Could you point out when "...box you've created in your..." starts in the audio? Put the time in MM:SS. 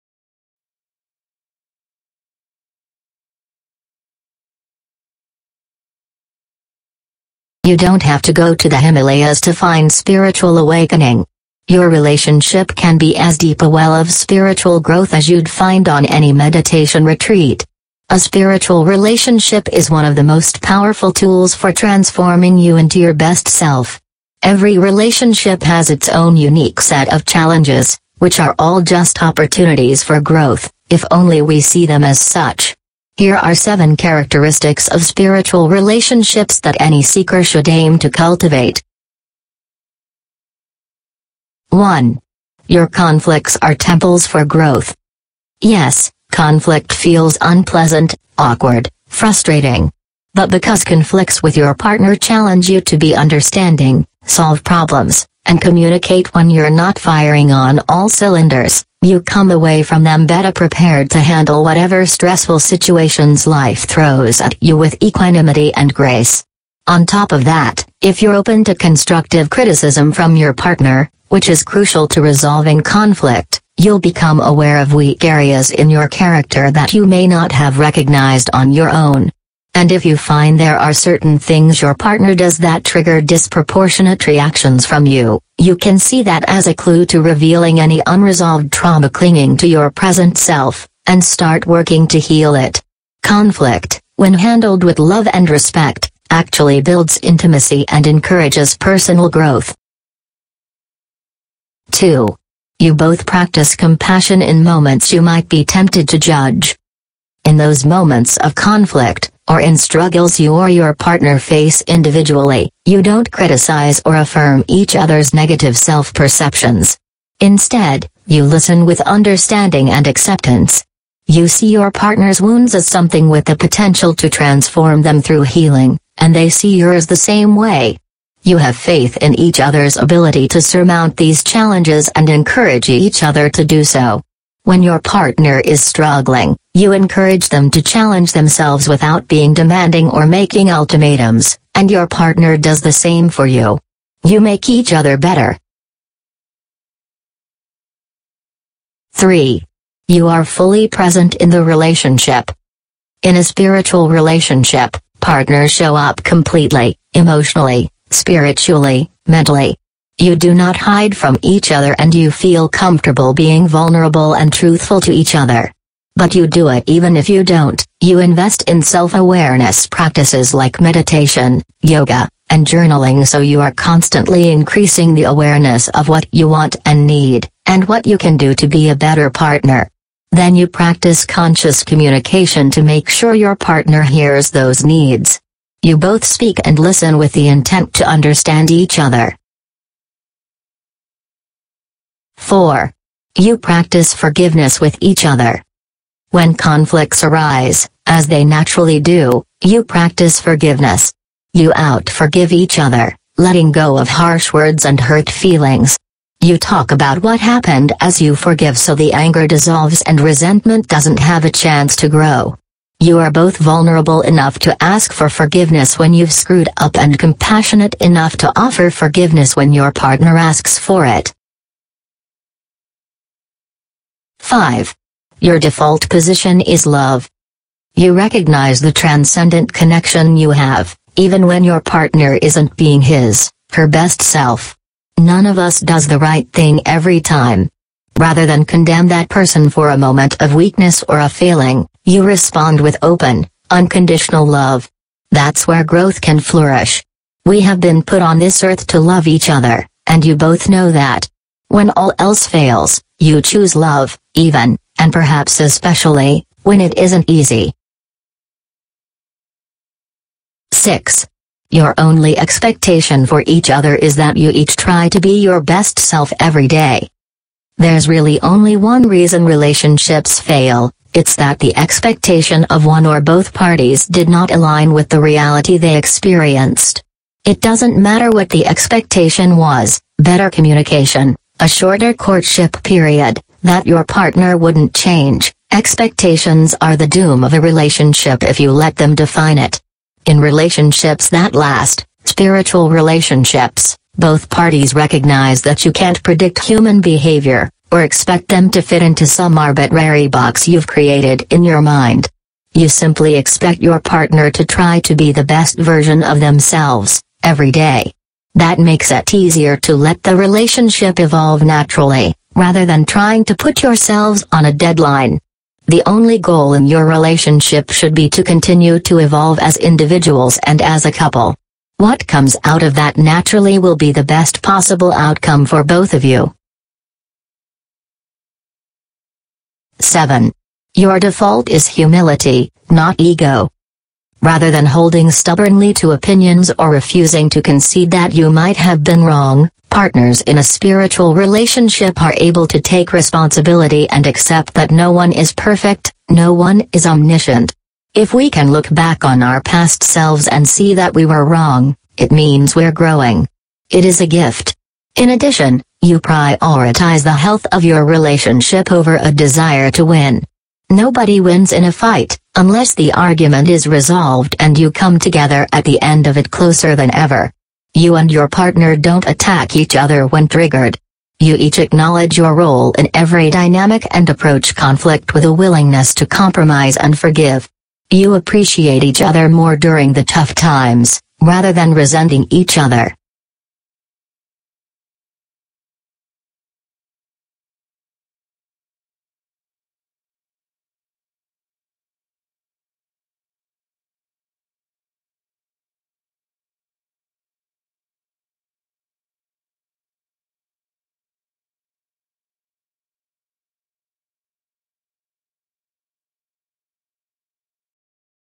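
05:00.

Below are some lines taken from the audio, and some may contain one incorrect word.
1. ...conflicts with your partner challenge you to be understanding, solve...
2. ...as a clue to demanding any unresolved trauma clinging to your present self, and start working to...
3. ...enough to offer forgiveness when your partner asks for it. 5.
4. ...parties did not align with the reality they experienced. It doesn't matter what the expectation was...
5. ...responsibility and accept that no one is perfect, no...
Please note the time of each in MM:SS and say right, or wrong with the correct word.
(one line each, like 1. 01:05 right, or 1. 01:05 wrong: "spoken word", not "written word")
1. 00:50 right
2. 01:26 wrong: "revealing", not "demanding"
3. 03:38 right
4. 04:33 right
5. 05:43 right.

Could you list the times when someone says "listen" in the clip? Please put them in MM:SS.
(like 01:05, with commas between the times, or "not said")
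01:58, 03:06.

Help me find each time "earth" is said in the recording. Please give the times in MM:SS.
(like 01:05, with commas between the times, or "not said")
04:08.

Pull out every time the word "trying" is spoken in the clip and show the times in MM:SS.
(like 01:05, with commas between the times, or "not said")
05:13.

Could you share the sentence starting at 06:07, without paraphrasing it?
You and your partner don't attack each other when triggered.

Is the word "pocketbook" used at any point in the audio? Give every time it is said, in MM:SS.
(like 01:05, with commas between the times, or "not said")
not said.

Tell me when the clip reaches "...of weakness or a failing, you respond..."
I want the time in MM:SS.
04:00.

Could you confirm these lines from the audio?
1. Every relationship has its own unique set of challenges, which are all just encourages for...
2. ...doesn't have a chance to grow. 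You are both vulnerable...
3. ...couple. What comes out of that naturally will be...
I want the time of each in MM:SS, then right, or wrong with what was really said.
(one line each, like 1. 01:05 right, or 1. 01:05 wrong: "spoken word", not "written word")
1. 00:24 wrong: "opportunities", not "encourages"
2. 03:30 right
3. 05:21 right.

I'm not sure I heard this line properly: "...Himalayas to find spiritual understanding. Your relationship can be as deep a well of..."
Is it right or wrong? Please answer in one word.
wrong.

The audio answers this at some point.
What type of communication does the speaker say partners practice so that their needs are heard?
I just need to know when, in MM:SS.
03:01.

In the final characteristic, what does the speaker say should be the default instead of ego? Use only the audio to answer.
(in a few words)
Humility.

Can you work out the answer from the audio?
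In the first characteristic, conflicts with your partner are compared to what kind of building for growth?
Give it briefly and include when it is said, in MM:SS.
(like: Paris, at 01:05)
Temples, at 00:43.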